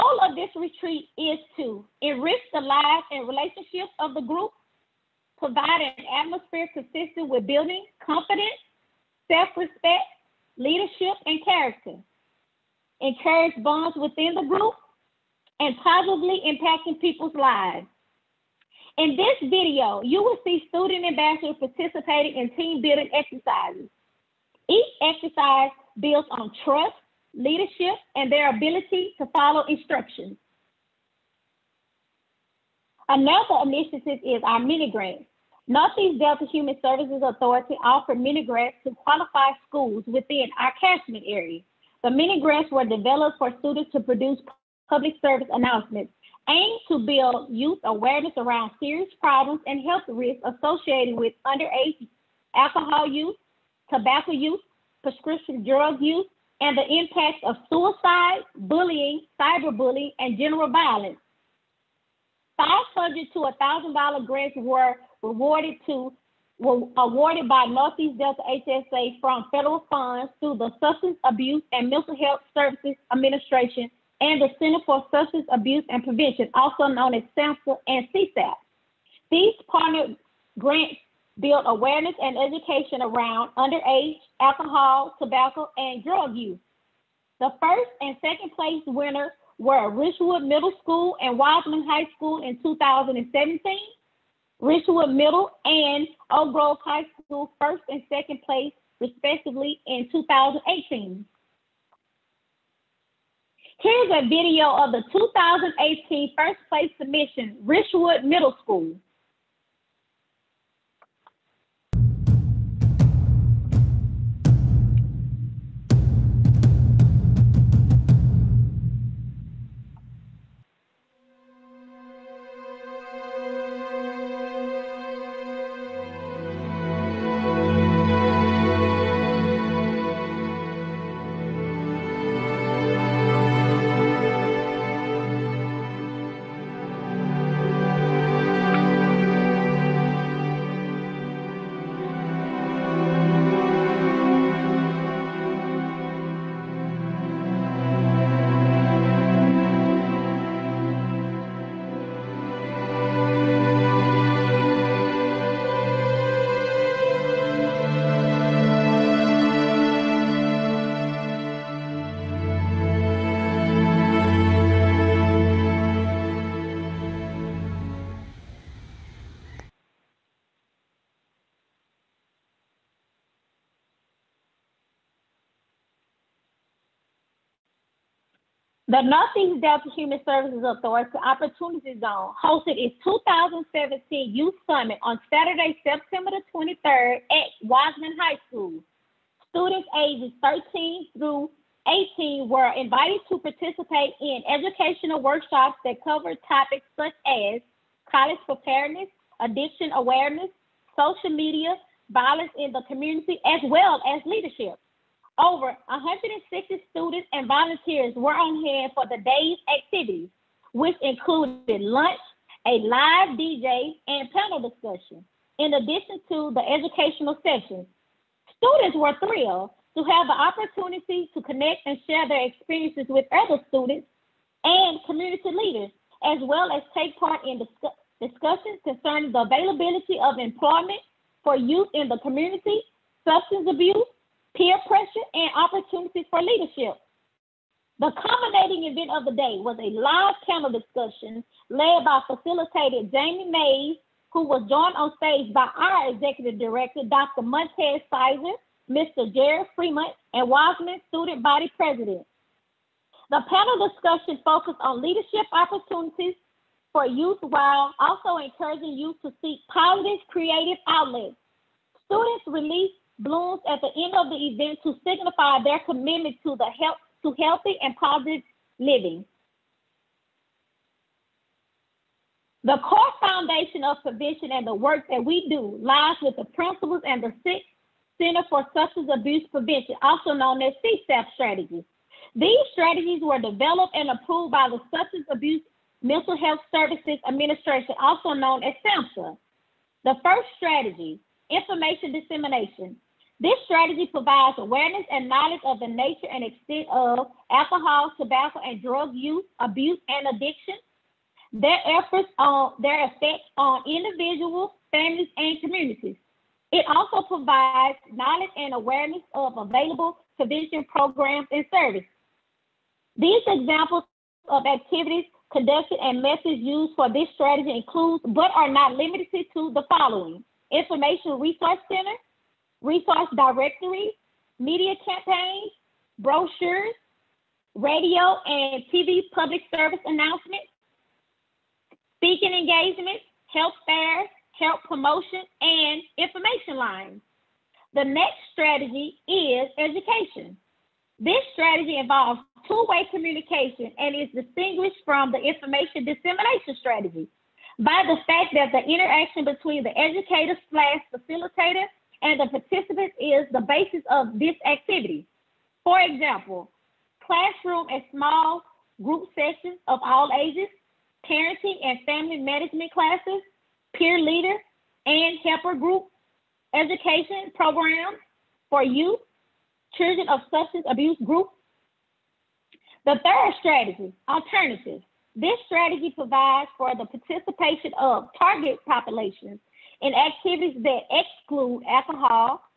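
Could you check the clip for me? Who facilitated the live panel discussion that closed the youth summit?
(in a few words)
Jamie Mays.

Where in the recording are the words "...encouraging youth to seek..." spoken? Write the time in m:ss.
4:18.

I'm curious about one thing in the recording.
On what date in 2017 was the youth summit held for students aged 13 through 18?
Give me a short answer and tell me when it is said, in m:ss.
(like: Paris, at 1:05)
September 23, at 3:05.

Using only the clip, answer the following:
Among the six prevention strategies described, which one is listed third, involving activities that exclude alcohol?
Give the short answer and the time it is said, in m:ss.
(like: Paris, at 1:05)
Alternatives, at 6:14.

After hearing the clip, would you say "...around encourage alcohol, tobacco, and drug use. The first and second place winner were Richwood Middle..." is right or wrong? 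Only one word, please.
wrong.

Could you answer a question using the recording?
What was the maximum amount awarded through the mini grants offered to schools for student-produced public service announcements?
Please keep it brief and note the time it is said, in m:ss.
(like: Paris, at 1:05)
$1,000, at 1:03.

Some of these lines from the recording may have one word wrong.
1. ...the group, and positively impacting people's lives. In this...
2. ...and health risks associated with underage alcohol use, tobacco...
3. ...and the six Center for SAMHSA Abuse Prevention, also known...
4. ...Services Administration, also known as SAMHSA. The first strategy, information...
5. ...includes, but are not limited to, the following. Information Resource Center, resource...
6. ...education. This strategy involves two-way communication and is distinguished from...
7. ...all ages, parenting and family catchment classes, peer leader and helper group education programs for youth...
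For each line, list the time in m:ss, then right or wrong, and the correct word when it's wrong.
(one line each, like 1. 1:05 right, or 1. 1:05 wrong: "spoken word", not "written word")
1. 0:14 right
2. 0:49 right
3. 4:37 wrong: "Substance", not "SAMHSA"
4. 4:46 right
5. 5:17 right
6. 5:39 right
7. 6:00 wrong: "management", not "catchment".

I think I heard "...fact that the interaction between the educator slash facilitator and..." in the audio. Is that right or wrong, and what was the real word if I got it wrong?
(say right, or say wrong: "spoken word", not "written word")
right.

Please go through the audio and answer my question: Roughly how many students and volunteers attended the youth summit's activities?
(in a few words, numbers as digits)
Over 160.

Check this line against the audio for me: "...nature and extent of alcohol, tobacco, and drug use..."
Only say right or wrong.
right.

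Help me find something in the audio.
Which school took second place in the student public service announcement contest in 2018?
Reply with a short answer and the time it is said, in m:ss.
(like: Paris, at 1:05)
Oak Grove High School, at 1:36.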